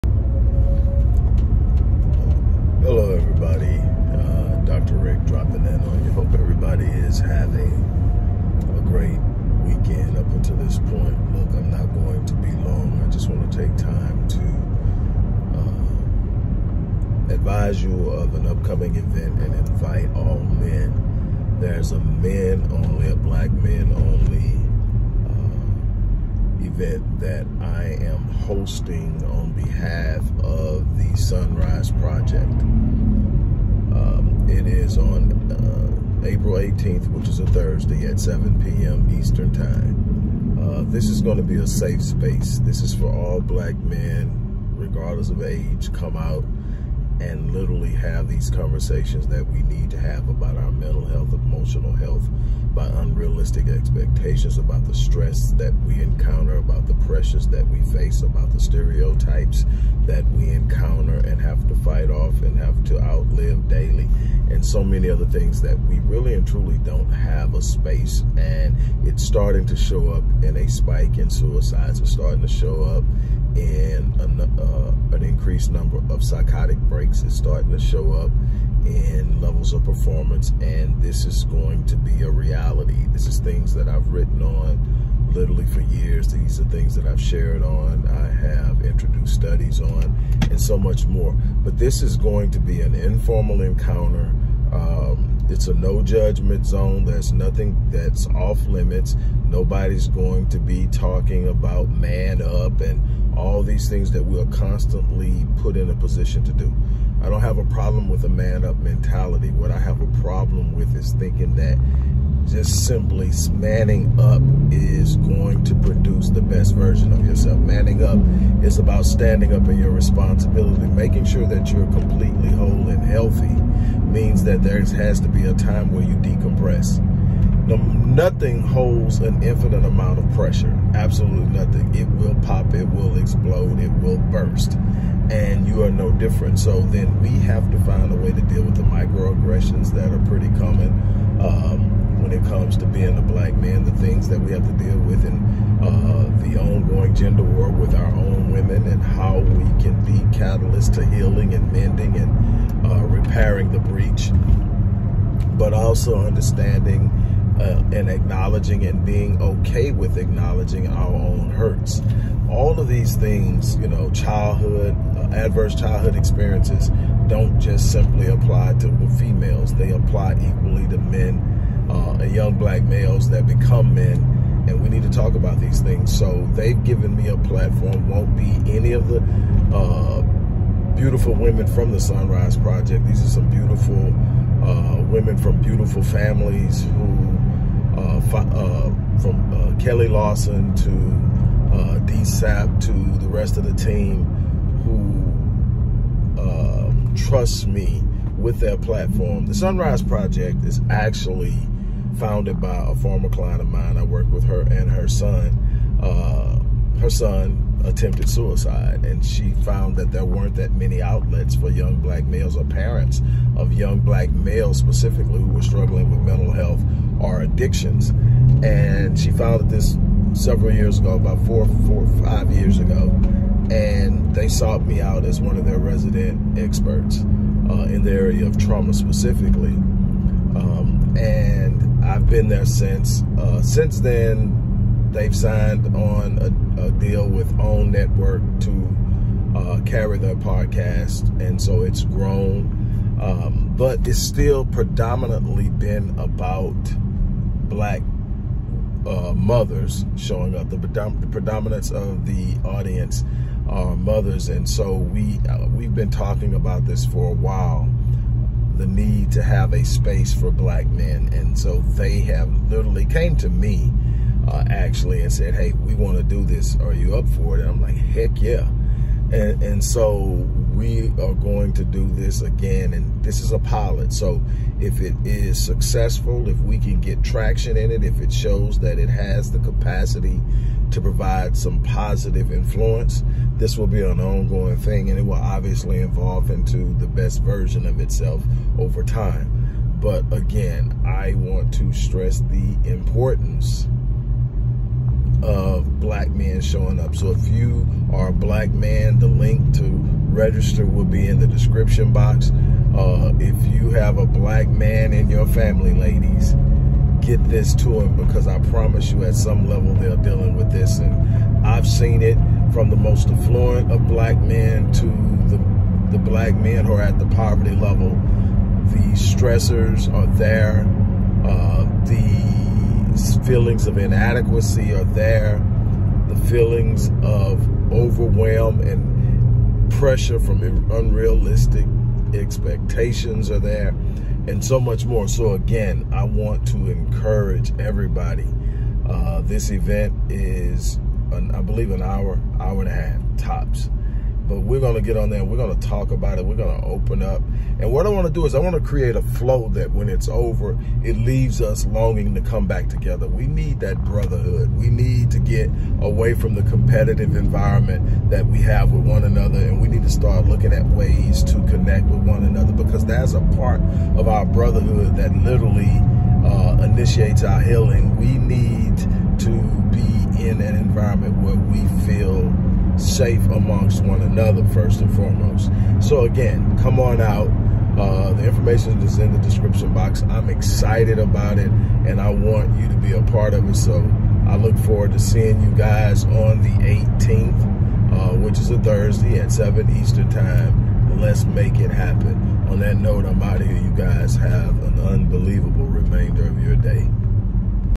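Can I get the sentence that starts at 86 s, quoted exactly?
These are things that I've shared on, I have introduced studies on, and so much more.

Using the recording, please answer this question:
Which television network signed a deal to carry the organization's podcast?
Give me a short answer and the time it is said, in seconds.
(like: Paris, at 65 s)
OWN Network, at 237 s.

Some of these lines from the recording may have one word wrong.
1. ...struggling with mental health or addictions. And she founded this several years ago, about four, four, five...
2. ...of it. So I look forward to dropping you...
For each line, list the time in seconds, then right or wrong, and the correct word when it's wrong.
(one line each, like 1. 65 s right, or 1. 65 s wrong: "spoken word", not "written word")
1. 215 s right
2. 383 s wrong: "seeing", not "dropping".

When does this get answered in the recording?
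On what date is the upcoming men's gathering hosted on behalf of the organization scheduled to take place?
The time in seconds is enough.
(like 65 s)
36 s.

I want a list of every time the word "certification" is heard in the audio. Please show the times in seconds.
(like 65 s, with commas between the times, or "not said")
not said.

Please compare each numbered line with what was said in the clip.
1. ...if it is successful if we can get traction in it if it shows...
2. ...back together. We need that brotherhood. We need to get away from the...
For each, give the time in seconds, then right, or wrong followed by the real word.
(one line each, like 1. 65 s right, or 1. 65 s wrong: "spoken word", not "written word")
1. 274 s right
2. 352 s right.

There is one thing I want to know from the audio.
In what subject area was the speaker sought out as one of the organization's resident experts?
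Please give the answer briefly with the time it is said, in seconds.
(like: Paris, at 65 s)
trauma, at 228 s.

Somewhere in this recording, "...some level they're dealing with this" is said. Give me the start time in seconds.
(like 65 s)
309 s.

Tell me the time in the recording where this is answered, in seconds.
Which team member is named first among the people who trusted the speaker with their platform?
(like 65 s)
189 s.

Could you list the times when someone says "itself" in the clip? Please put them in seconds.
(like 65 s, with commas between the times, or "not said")
287 s.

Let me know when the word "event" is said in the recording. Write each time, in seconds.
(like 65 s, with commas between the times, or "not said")
18 s, 26 s, 339 s.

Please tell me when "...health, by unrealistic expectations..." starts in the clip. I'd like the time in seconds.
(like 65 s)
51 s.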